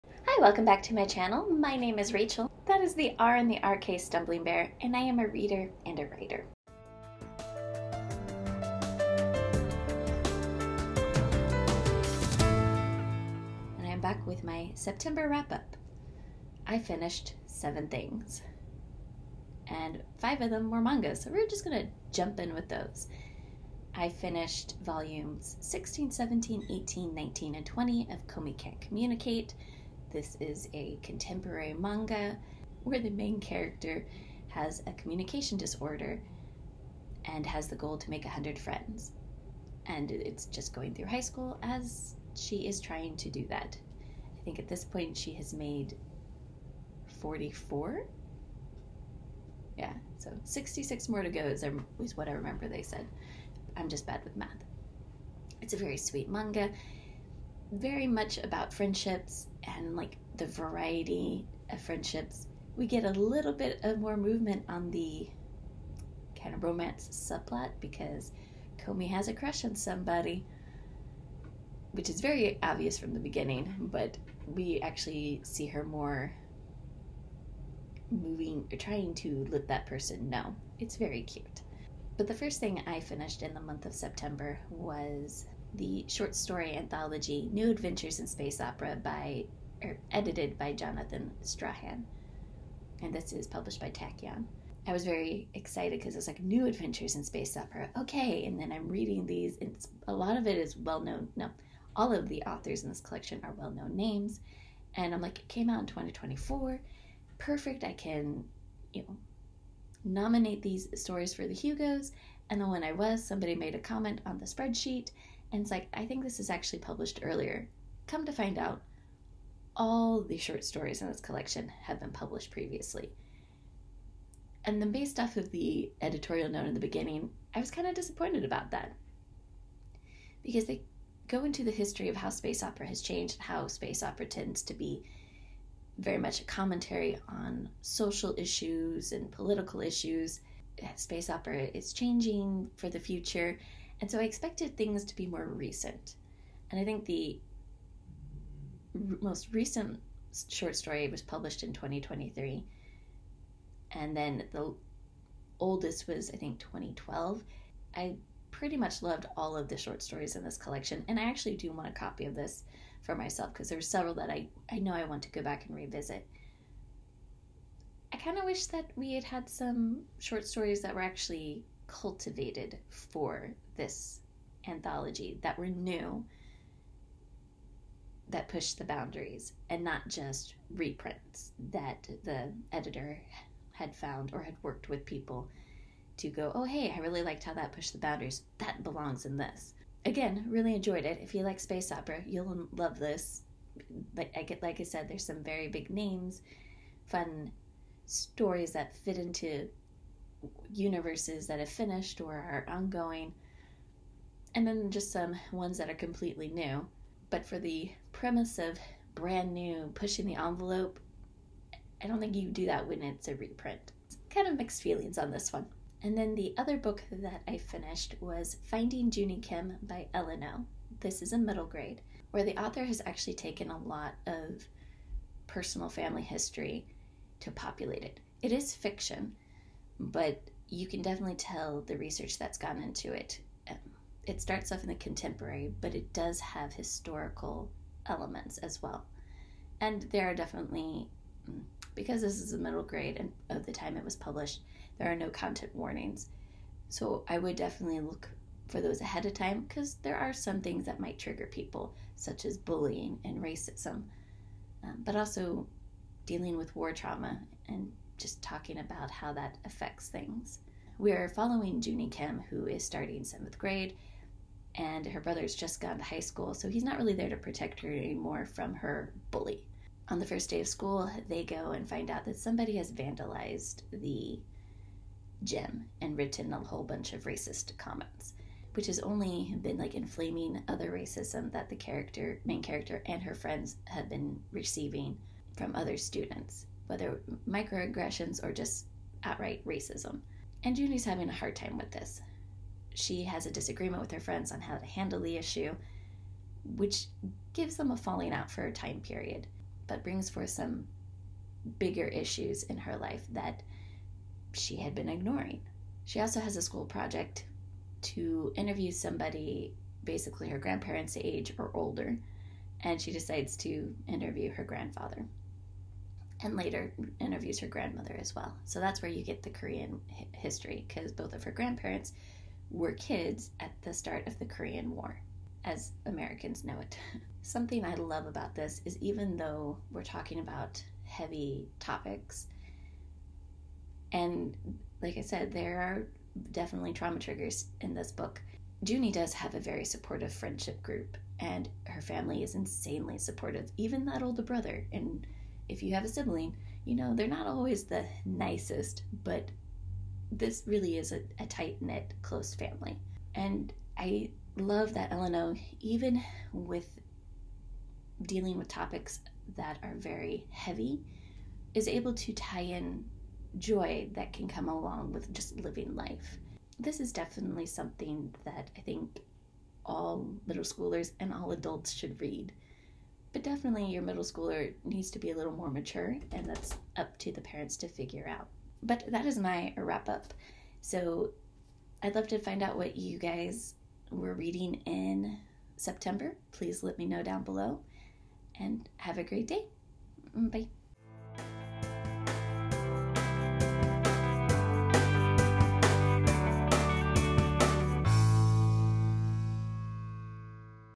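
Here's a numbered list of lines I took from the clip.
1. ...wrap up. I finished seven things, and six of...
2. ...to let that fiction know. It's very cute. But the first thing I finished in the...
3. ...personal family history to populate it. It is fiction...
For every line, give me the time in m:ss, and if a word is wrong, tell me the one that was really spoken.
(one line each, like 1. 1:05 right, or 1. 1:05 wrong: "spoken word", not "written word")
1. 0:15 wrong: "five", not "six"
2. 1:19 wrong: "person", not "fiction"
3. 3:45 right.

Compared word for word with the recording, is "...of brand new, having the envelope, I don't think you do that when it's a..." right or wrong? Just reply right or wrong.
wrong.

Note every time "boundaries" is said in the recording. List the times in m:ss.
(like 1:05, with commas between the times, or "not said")
2:58, 3:07.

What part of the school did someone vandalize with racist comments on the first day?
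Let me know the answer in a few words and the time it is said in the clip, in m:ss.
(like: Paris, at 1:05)
The gym, at 4:33.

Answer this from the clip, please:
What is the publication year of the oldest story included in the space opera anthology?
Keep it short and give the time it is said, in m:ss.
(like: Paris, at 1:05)
2012, at 2:36.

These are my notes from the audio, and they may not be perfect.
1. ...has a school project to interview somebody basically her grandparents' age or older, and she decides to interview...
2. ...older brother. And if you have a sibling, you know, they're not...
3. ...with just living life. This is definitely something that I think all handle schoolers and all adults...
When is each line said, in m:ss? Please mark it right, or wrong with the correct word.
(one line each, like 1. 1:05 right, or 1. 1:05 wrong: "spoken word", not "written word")
1. 5:06 right
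2. 5:44 right
3. 6:05 wrong: "middle", not "handle".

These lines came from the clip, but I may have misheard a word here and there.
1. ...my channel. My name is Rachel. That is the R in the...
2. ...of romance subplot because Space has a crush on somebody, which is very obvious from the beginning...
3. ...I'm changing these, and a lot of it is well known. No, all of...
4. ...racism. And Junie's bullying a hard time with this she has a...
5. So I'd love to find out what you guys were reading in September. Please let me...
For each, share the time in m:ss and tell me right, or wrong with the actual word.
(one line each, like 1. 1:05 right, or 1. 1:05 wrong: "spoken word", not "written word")
1. 0:00 right
2. 1:06 wrong: "Komi", not "Space"
3. 1:38 wrong: "reading", not "changing"
4. 4:49 wrong: "having", not "bullying"
5. 6:20 right.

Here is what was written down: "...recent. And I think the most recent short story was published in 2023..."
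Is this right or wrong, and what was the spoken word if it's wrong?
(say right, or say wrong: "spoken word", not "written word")
right.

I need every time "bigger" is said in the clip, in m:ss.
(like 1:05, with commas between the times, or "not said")
5:01.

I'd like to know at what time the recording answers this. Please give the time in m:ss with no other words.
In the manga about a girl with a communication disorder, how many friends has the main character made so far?
0:47.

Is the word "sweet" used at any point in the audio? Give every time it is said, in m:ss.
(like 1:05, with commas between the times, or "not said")
0:55.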